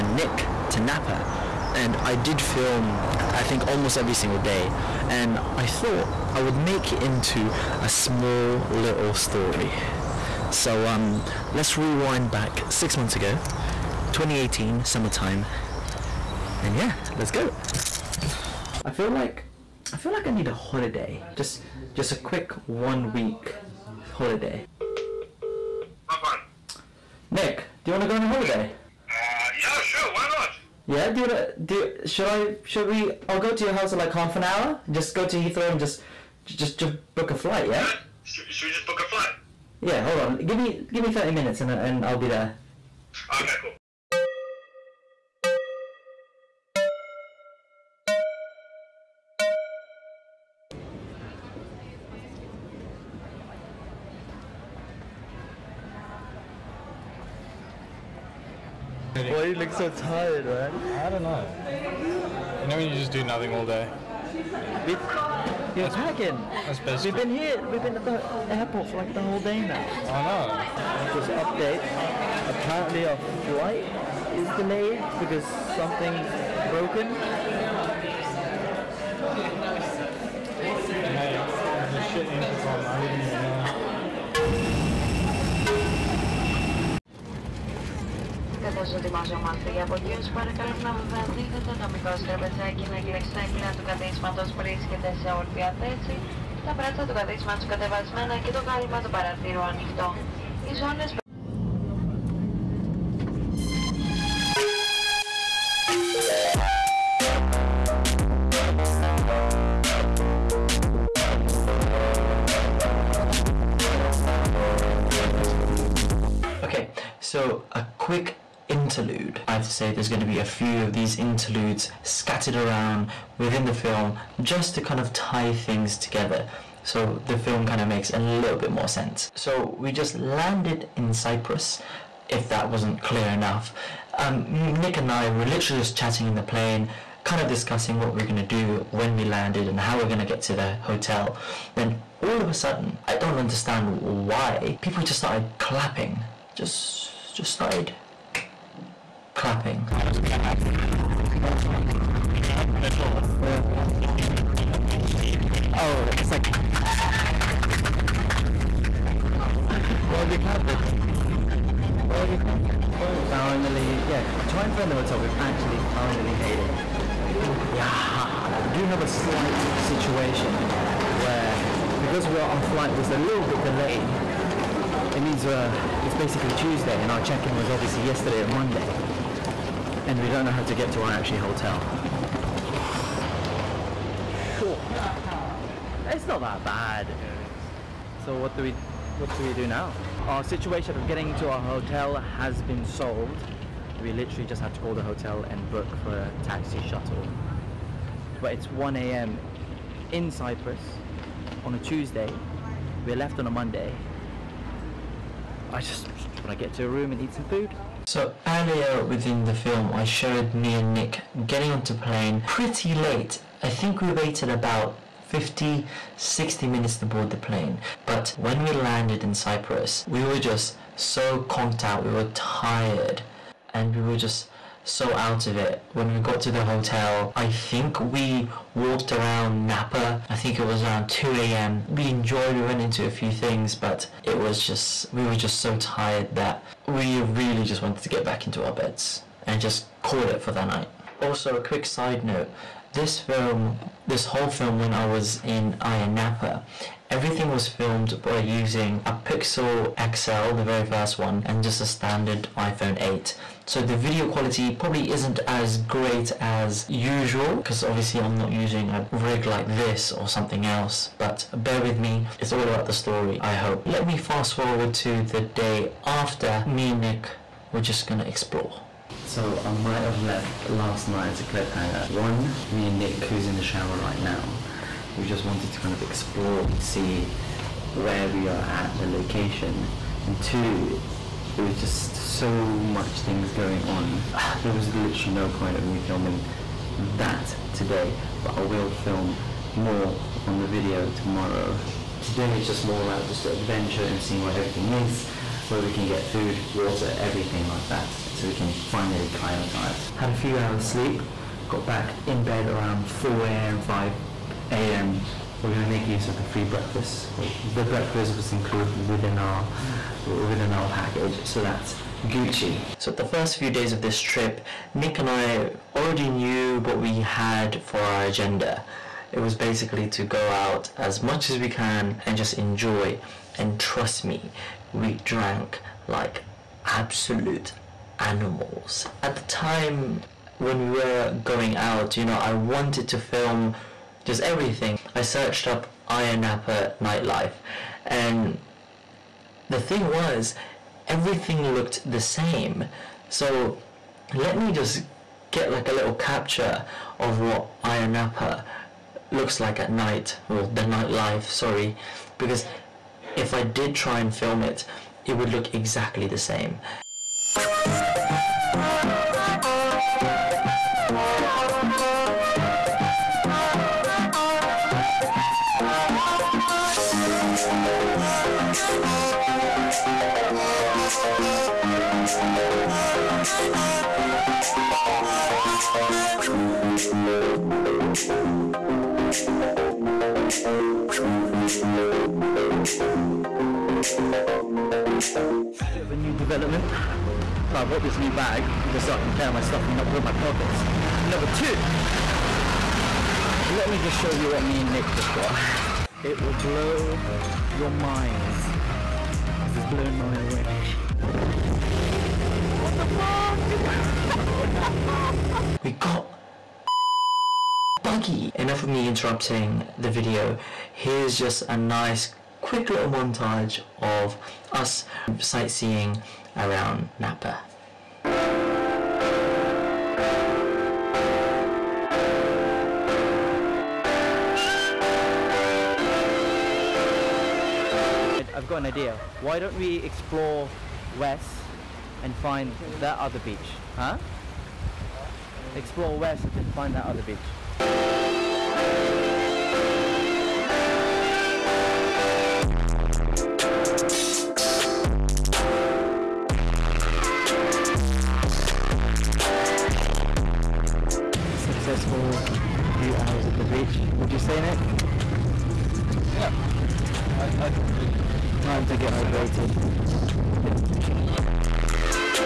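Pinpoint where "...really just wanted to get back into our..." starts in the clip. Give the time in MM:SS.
03:57.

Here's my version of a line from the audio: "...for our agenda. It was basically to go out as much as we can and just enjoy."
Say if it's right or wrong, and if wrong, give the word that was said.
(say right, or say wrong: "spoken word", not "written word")
right.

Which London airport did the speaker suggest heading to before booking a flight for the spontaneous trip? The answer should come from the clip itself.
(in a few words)
Heathrow.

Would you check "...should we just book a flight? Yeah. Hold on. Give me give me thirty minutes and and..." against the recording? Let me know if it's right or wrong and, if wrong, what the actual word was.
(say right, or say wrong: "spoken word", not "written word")
right.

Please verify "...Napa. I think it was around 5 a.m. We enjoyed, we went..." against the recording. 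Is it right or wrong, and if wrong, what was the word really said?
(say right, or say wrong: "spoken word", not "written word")
wrong: "2", not "5".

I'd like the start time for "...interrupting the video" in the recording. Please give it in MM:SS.
06:49.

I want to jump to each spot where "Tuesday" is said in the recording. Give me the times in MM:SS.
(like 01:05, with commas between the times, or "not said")
02:56, 03:21.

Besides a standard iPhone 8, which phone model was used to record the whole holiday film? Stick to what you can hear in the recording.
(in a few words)
Pixel XL.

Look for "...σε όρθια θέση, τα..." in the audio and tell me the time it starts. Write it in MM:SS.
01:35.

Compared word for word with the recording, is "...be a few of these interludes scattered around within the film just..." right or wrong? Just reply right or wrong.
right.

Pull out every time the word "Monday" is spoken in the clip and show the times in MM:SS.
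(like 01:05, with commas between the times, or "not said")
02:58, 03:23.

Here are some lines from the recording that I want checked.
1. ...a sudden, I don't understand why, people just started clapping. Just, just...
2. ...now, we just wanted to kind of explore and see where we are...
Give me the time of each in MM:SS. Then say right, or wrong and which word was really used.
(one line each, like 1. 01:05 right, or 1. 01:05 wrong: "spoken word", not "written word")
1. 02:22 right
2. 04:34 right.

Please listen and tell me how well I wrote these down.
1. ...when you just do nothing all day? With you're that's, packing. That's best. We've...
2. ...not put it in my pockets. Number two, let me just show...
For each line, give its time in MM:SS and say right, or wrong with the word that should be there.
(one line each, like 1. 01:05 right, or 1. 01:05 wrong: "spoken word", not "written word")
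1. 01:02 right
2. 06:29 right.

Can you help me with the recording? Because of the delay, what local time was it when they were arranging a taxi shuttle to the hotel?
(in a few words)
1 a.m.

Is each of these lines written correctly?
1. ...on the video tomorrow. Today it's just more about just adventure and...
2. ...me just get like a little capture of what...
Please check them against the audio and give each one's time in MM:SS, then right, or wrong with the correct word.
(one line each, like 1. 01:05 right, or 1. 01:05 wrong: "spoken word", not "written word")
1. 04:50 right
2. 05:44 right.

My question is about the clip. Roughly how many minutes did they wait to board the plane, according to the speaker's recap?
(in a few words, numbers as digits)
50 to 60.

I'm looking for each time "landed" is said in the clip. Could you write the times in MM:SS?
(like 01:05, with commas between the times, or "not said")
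02:10, 02:19, 03:38.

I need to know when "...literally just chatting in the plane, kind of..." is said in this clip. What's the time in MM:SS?
02:15.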